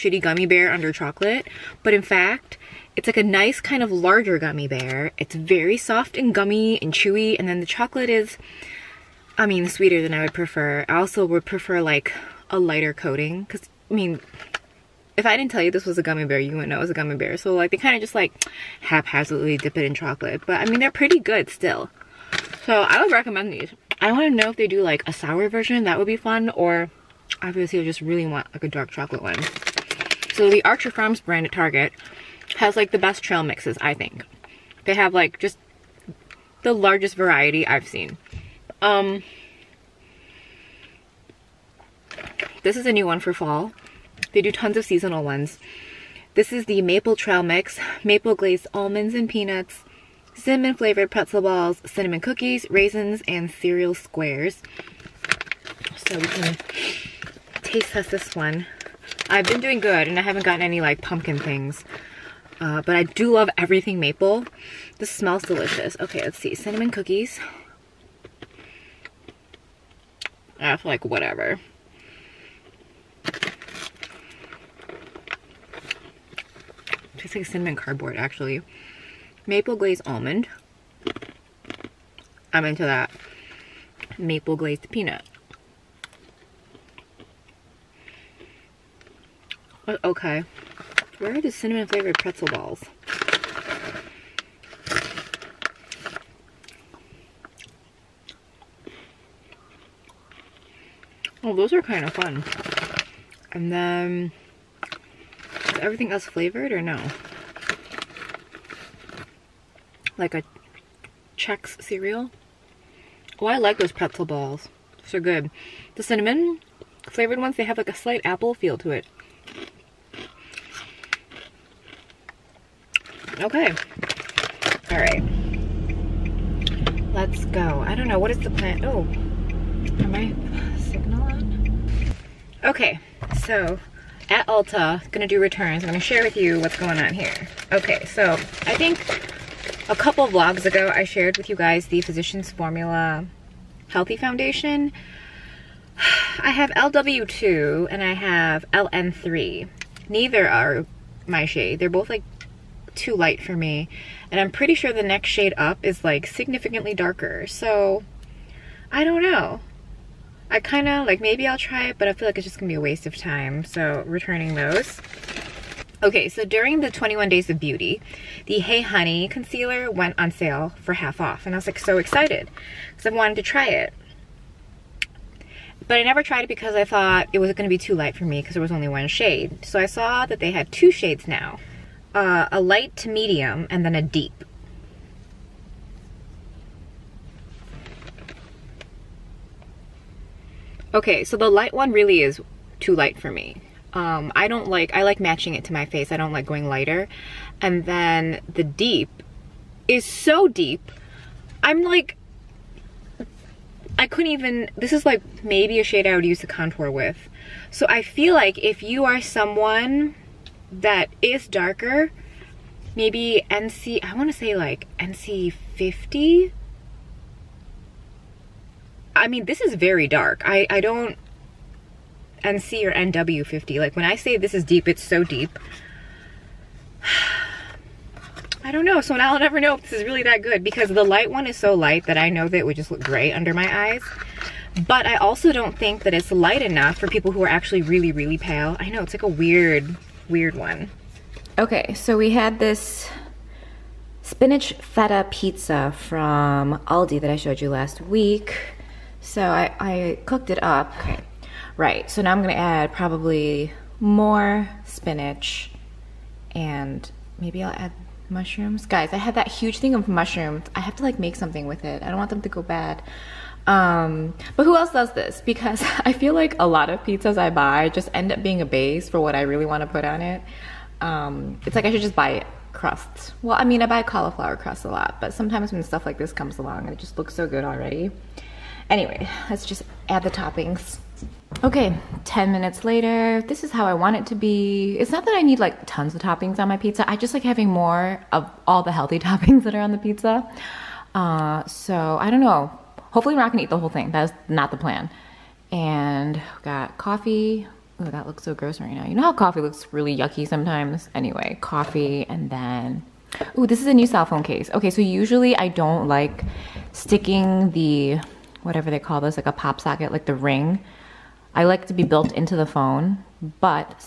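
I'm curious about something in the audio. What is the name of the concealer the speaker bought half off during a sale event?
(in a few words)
Hey Honey.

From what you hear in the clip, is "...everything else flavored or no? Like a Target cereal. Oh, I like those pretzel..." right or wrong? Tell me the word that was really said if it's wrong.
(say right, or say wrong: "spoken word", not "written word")
wrong: "Chex", not "Target".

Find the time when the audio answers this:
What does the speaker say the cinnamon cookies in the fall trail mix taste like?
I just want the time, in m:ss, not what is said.
1:17.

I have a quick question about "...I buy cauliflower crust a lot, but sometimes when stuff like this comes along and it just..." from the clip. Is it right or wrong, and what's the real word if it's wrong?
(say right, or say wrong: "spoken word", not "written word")
right.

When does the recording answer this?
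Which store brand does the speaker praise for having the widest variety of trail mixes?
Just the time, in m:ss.
0:30.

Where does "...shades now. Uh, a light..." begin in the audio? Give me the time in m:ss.
3:00.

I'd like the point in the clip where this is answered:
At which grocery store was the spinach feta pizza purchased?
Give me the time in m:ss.
4:06.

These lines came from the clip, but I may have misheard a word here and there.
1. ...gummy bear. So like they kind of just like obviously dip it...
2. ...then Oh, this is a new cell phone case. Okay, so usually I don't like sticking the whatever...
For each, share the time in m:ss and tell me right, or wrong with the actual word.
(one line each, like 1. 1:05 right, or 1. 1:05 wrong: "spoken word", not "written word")
1. 0:16 wrong: "haphazardly", not "obviously"
2. 5:02 right.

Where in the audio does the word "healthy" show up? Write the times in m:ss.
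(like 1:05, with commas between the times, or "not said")
2:23, 4:48.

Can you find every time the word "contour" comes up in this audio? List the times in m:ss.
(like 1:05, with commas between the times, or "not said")
3:26.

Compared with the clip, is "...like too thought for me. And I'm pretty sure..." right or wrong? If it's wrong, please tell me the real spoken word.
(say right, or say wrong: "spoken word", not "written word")
wrong: "light", not "thought".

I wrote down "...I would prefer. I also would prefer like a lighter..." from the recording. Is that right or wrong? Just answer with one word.
right.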